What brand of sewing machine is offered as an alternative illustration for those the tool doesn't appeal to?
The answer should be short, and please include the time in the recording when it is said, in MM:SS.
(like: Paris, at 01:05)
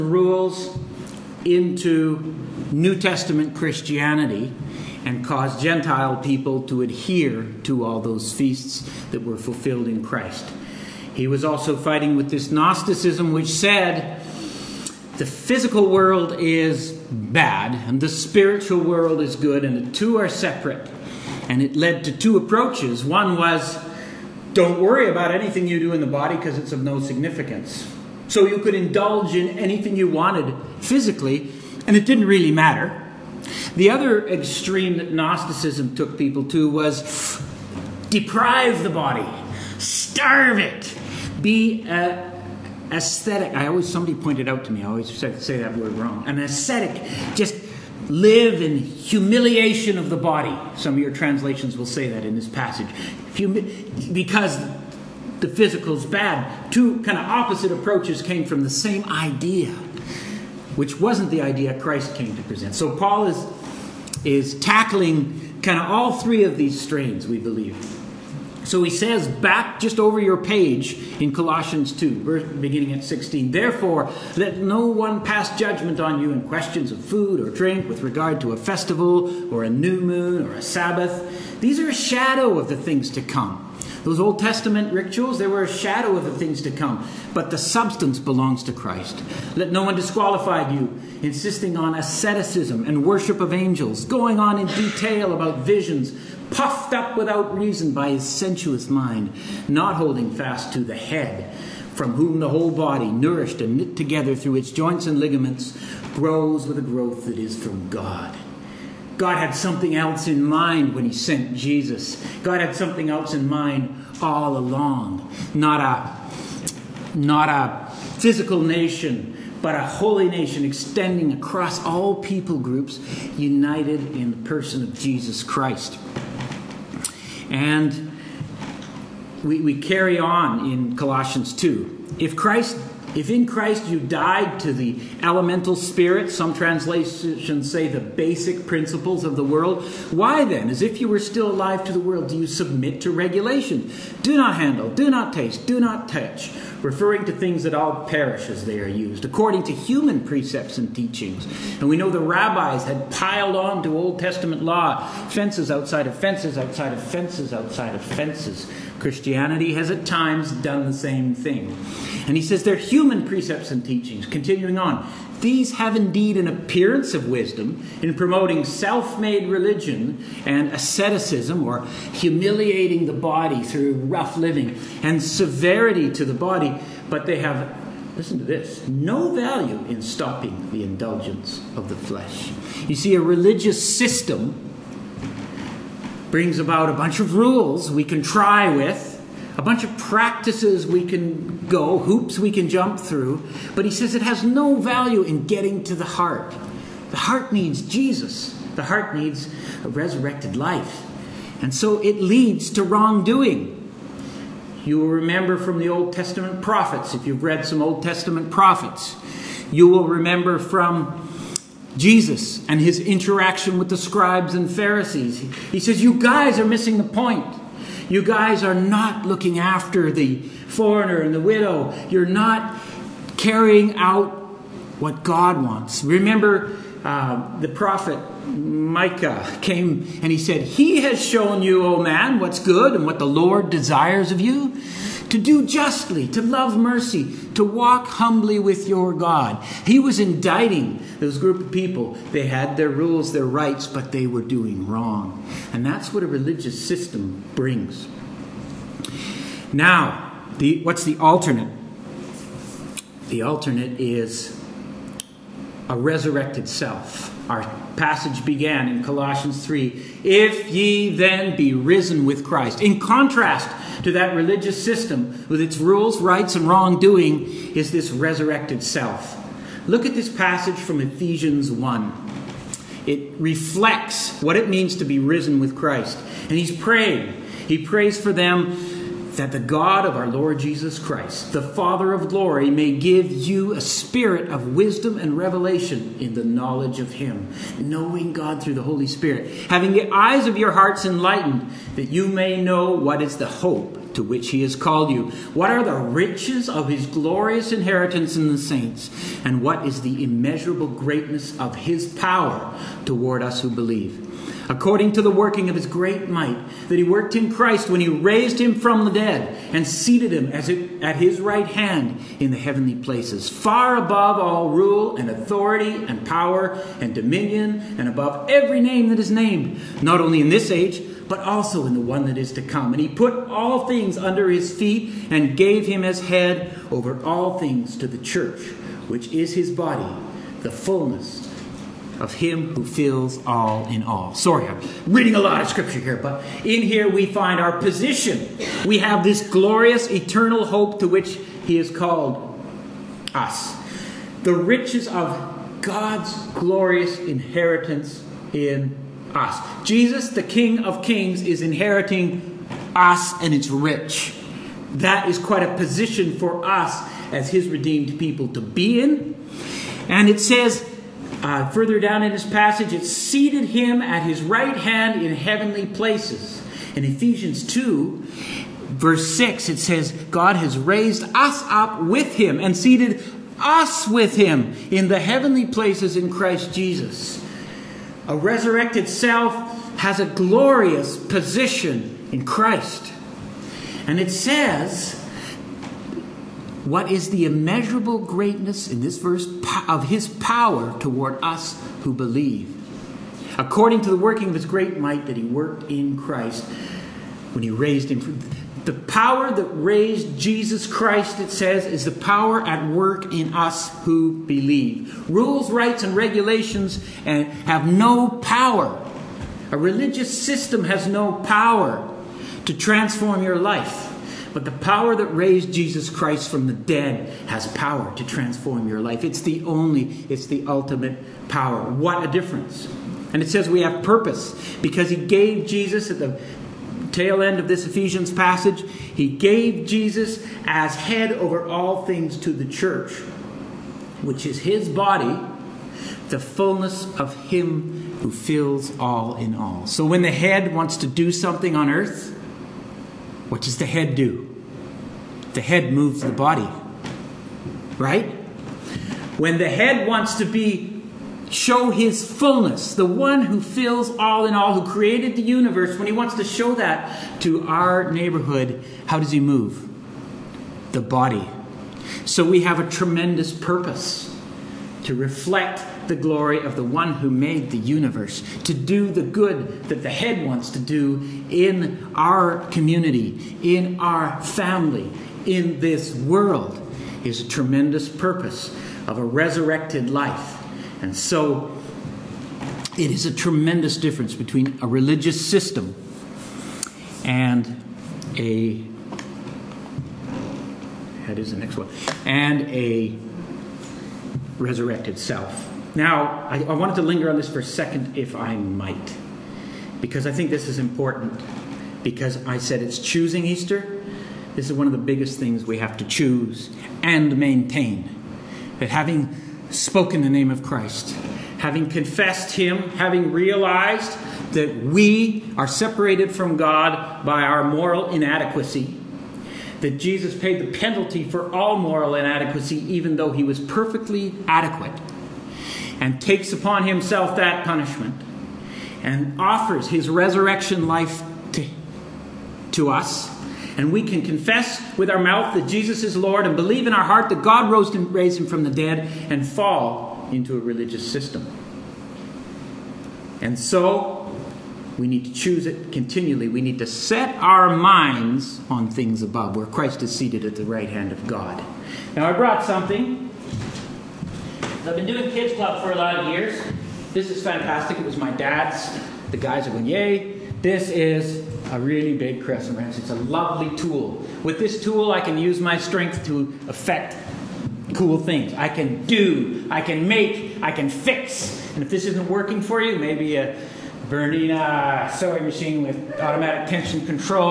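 Bernina, at 09:34.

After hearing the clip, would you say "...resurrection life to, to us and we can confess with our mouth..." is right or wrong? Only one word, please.
right.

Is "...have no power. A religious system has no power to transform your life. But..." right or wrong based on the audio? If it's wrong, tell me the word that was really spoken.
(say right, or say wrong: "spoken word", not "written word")
right.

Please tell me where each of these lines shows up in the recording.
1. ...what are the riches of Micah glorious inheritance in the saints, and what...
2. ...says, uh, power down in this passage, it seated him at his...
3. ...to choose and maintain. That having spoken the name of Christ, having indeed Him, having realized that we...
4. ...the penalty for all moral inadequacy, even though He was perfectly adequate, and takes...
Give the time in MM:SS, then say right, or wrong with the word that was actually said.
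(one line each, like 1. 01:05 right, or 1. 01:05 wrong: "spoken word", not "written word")
1. 04:55 wrong: "His", not "Micah"
2. 06:00 wrong: "further", not "power"
3. 08:25 wrong: "confessed", not "indeed"
4. 08:40 right.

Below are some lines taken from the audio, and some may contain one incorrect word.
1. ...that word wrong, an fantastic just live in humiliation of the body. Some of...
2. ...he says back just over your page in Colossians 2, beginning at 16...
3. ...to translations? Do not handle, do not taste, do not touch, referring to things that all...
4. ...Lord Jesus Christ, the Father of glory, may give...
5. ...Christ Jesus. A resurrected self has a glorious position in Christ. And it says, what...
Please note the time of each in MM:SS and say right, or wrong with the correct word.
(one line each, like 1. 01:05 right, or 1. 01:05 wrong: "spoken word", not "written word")
1. 00:45 wrong: "ascetic", not "fantastic"
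2. 01:08 right
3. 02:23 wrong: "regulations", not "translations"
4. 04:40 right
5. 06:16 right.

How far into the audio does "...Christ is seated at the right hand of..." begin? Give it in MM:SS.
09:09.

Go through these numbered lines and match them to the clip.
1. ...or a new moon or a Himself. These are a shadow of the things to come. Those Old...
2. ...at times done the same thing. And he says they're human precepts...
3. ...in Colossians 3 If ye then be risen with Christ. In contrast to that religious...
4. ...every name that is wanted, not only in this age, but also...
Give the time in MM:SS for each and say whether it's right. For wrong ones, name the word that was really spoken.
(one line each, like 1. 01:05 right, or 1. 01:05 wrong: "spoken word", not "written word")
1. 01:19 wrong: "Sabbath", not "Himself"
2. 02:39 right
3. 04:18 right
4. 05:18 wrong: "named", not "wanted".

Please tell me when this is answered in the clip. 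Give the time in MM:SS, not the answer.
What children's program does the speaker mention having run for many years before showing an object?
09:15.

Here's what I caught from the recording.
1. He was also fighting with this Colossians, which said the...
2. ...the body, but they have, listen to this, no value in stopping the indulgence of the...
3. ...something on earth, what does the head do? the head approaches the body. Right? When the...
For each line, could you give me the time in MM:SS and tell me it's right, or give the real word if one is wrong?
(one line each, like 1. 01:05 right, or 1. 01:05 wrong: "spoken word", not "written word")
1. 00:11 wrong: "Gnosticism", not "Colossians"
2. 02:56 right
3. 07:21 wrong: "moves", not "approaches".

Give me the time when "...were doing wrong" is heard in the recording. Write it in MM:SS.
04:04.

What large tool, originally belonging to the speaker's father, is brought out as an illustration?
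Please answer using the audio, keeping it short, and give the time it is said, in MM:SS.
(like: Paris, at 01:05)
crescent wrench, at 09:22.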